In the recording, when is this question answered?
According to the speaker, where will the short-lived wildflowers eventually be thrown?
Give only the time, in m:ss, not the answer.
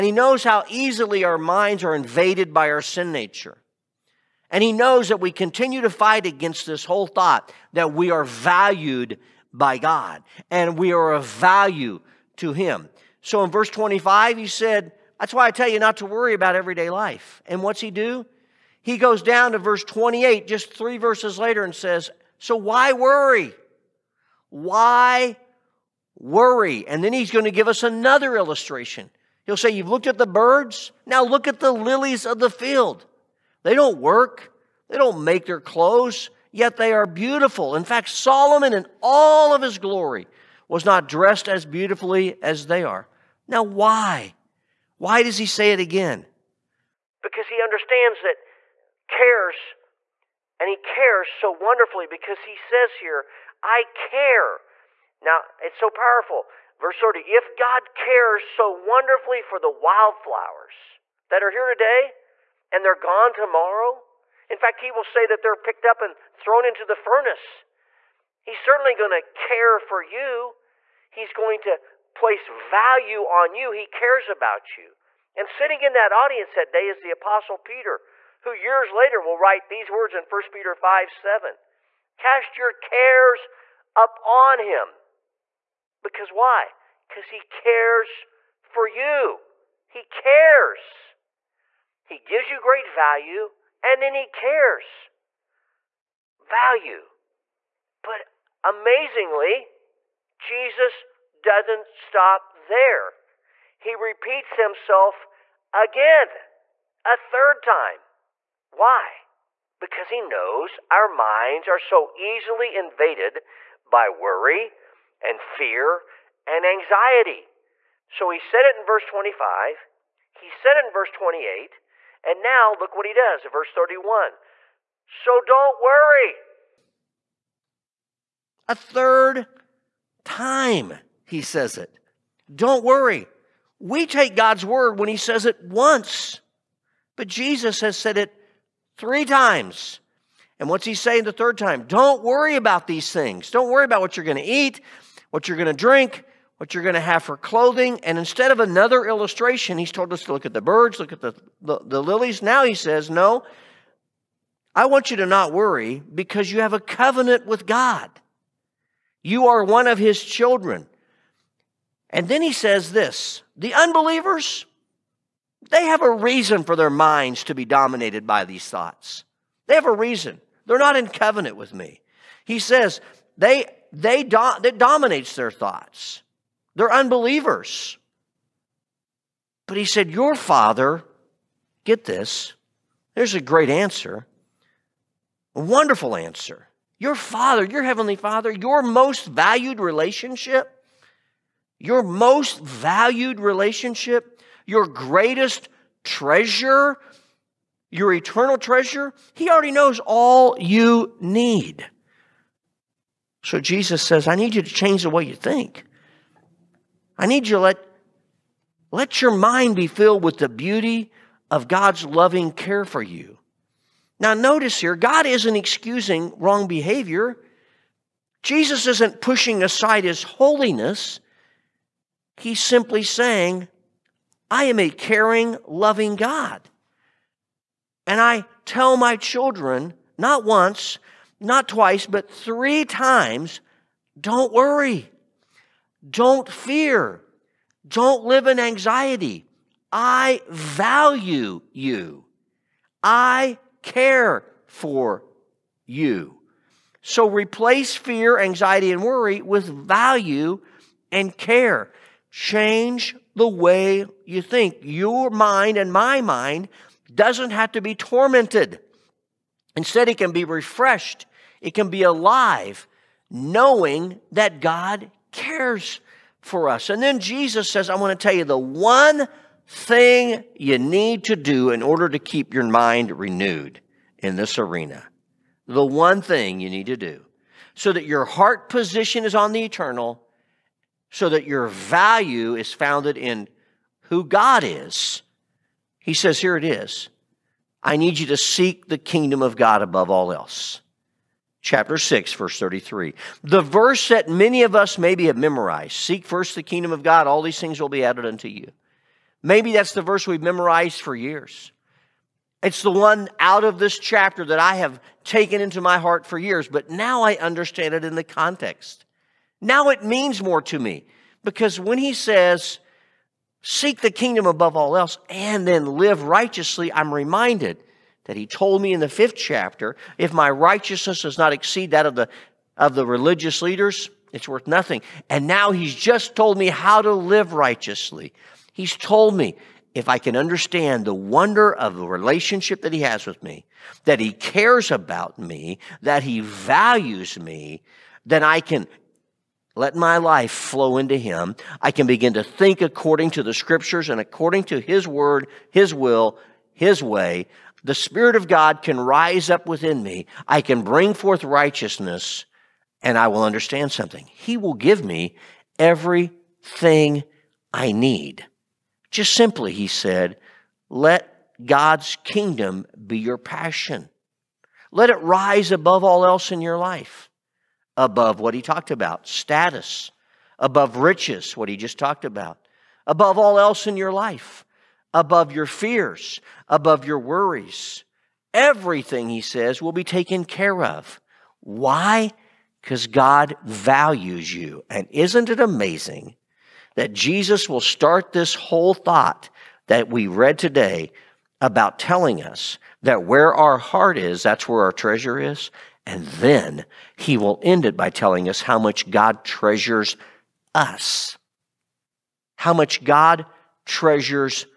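1:06.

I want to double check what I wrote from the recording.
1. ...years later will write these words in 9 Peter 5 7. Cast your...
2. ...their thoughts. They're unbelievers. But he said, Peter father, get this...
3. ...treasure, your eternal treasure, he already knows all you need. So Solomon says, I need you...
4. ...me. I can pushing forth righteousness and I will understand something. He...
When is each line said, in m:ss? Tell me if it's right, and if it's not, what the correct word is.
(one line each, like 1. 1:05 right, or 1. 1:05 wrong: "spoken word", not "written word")
1. 1:18 wrong: "1", not "9"
2. 2:55 wrong: "Your", not "Peter"
3. 3:16 wrong: "Jesus", not "Solomon"
4. 5:50 wrong: "bring", not "pushing".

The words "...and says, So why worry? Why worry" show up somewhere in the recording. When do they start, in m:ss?
0:21.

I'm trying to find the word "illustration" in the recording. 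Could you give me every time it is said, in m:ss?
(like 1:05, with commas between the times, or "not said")
0:28, 2:29.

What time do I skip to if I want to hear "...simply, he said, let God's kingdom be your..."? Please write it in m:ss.
5:59.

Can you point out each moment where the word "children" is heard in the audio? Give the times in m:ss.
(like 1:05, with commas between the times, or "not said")
2:40, 3:49.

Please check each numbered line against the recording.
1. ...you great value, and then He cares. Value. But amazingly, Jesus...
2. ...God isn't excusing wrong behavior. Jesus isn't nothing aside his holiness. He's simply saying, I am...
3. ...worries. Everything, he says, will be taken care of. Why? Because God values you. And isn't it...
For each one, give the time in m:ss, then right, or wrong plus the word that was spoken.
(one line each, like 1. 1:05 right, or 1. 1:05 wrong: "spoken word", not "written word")
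1. 1:32 right
2. 3:34 wrong: "pushing", not "nothing"
3. 6:17 right.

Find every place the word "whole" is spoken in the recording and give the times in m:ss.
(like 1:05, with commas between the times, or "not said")
0:06, 6:28.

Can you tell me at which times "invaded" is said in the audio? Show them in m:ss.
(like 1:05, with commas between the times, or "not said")
0:01, 1:52.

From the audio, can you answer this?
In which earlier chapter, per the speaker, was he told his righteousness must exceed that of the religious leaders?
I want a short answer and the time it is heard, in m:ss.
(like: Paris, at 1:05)
fifth chapter, at 5:19.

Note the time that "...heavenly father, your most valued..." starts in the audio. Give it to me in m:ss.
3:07.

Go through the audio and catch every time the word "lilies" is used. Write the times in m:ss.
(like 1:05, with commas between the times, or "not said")
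0:31, 2:32.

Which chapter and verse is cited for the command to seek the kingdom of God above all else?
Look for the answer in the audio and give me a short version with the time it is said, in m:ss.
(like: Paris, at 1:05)
chapter 6, verse 33, at 4:51.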